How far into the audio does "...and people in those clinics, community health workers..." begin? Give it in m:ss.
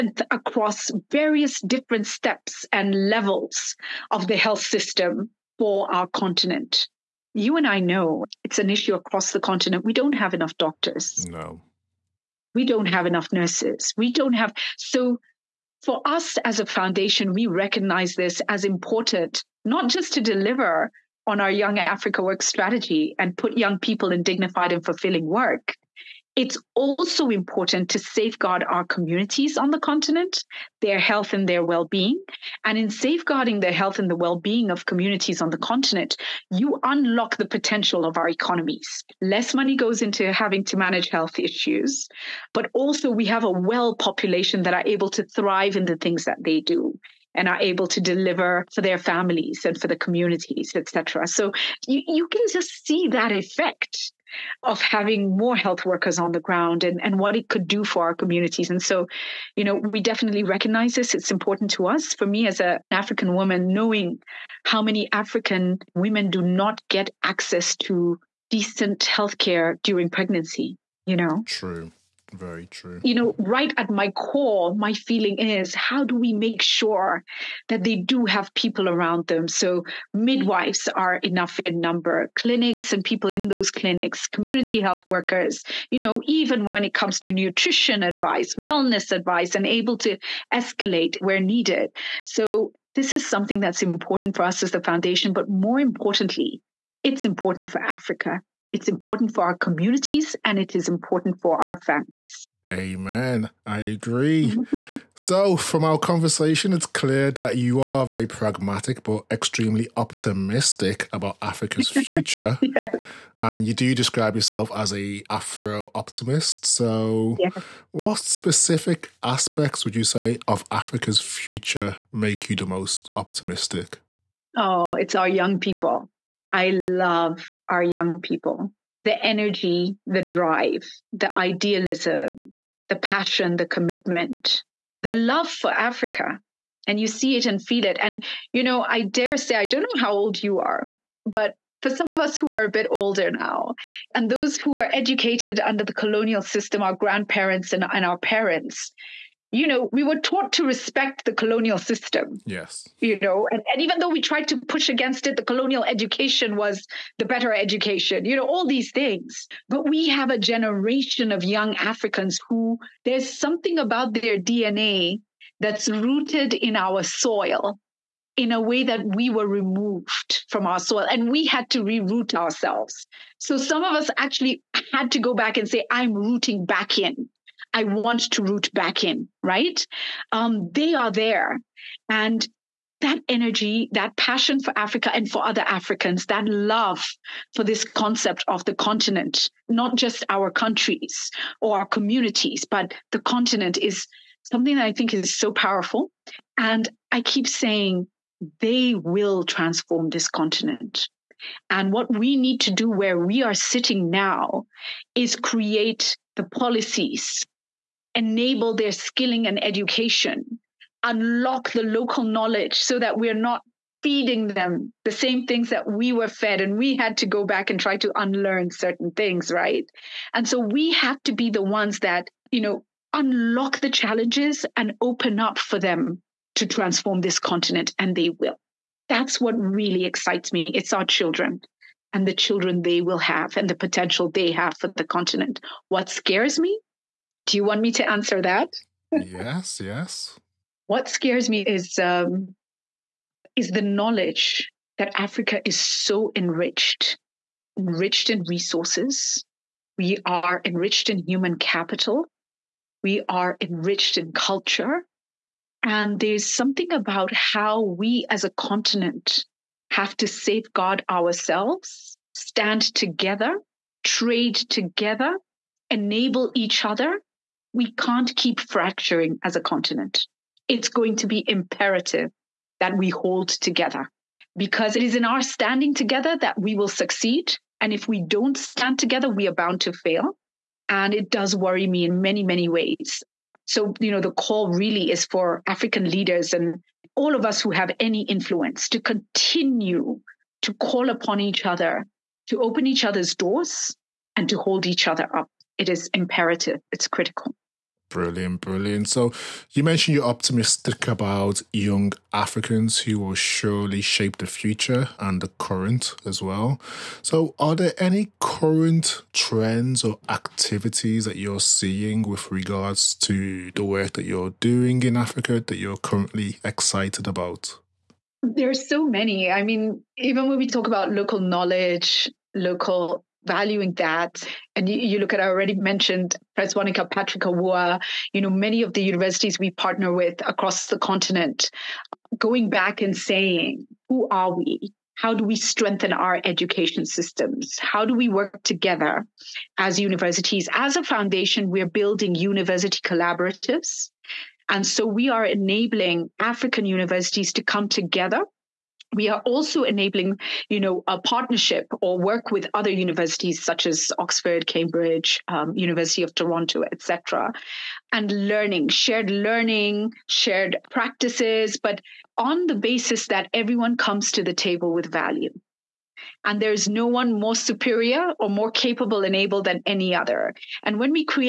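1:22.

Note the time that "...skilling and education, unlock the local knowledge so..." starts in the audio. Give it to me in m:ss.
3:28.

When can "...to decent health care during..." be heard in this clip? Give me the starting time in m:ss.
1:07.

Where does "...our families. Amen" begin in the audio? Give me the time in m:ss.
1:41.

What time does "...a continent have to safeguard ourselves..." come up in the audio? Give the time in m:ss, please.
4:18.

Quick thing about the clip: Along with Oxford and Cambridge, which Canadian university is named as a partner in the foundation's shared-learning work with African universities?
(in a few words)
University of Toronto.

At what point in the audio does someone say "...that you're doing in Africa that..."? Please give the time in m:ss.
5:14.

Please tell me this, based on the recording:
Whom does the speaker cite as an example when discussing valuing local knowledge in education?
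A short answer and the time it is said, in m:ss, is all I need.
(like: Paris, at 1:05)
Patrick Awuah, at 5:27.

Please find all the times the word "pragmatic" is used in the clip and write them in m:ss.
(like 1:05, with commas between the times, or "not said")
1:48.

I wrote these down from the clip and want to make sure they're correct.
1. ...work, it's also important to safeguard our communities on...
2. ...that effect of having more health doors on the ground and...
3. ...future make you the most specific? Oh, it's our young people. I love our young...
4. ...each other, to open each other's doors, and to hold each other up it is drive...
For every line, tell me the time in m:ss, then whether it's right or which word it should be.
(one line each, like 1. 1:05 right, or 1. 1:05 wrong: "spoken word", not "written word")
1. 0:25 right
2. 0:53 wrong: "workers", not "doors"
3. 2:01 wrong: "optimistic", not "specific"
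4. 4:51 wrong: "imperative", not "drive".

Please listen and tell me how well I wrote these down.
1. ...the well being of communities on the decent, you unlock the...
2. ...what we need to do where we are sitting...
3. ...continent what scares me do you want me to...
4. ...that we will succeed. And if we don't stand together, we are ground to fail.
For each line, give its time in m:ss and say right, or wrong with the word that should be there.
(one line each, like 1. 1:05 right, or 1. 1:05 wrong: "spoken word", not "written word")
1. 0:34 wrong: "continent", not "decent"
2. 3:21 right
3. 3:55 right
4. 4:36 wrong: "bound", not "ground".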